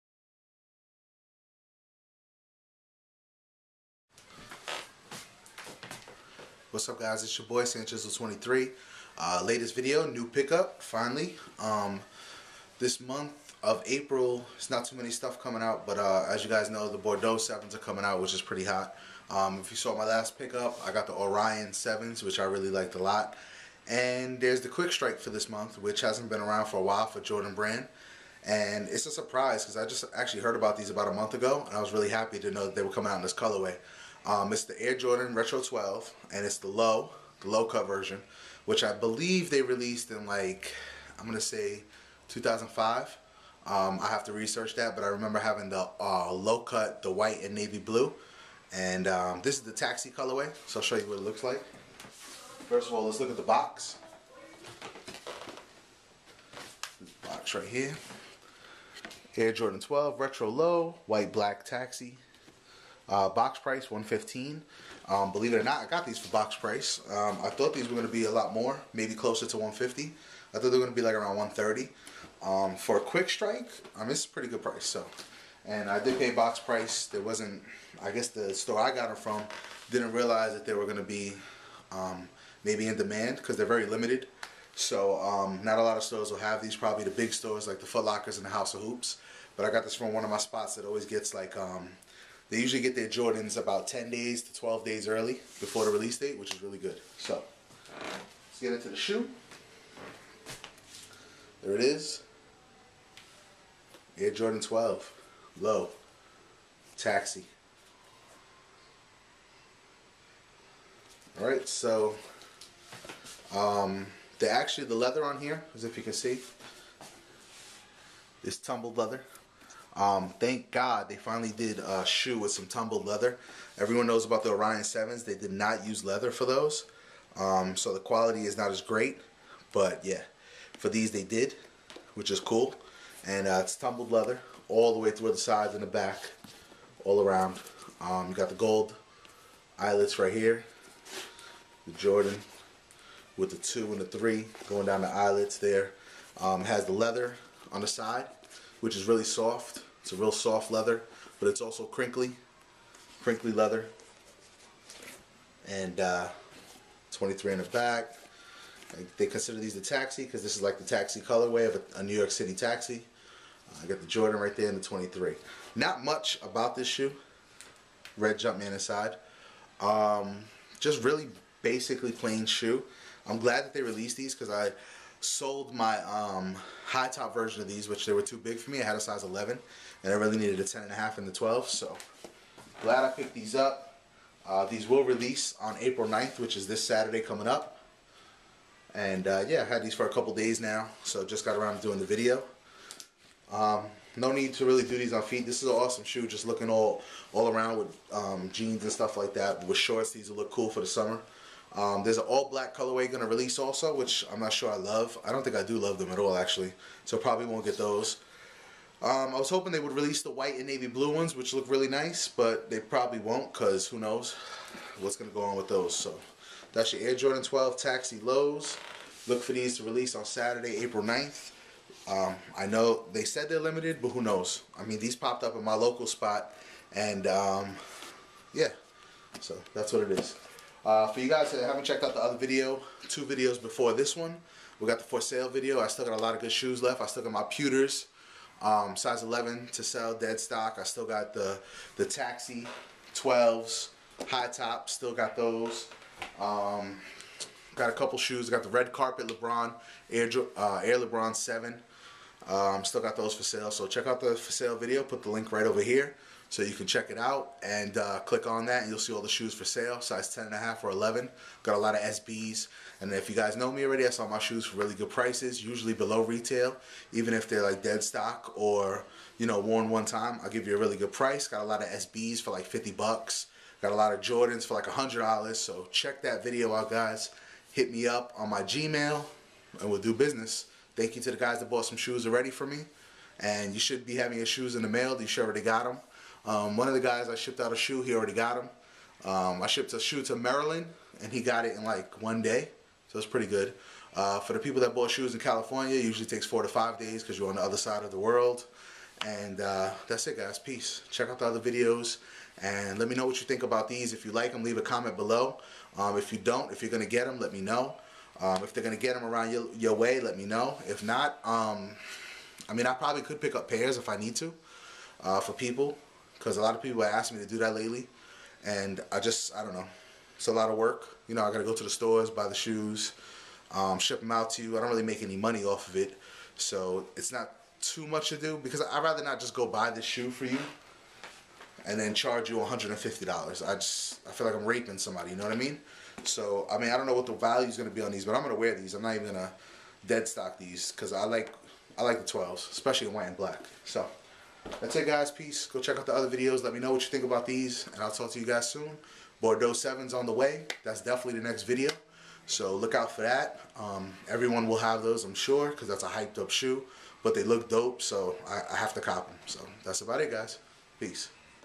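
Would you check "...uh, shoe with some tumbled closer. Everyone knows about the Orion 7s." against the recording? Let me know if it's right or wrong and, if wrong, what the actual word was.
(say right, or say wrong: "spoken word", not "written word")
wrong: "leather", not "closer".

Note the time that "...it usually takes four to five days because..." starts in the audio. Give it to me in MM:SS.
04:55.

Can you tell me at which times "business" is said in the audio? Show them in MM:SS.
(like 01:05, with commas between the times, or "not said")
04:40.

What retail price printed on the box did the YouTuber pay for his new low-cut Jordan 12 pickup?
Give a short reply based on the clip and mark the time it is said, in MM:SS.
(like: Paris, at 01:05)
$115, at 01:03.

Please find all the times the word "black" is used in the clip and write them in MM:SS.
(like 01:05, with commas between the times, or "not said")
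01:01, 03:22, 05:43.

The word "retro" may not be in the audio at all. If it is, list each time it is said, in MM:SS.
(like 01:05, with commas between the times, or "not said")
00:35, 01:00.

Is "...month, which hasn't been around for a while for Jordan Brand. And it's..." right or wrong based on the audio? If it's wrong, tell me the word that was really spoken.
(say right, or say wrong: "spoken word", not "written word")
right.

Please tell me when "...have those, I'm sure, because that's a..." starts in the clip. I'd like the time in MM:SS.
05:54.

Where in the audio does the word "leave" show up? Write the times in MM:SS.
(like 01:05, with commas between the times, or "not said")
05:04.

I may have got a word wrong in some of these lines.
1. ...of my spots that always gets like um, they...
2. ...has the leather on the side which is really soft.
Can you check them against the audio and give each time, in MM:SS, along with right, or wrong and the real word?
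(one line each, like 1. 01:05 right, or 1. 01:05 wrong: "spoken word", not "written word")
1. 01:30 right
2. 02:26 right.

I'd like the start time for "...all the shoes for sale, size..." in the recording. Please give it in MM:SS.
04:19.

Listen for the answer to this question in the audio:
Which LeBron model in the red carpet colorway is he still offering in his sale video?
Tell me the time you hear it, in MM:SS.
04:10.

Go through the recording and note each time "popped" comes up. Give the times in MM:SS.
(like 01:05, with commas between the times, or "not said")
03:45.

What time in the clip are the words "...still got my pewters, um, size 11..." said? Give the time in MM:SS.
03:57.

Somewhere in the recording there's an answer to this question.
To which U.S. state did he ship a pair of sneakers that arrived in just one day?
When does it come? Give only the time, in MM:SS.
04:50.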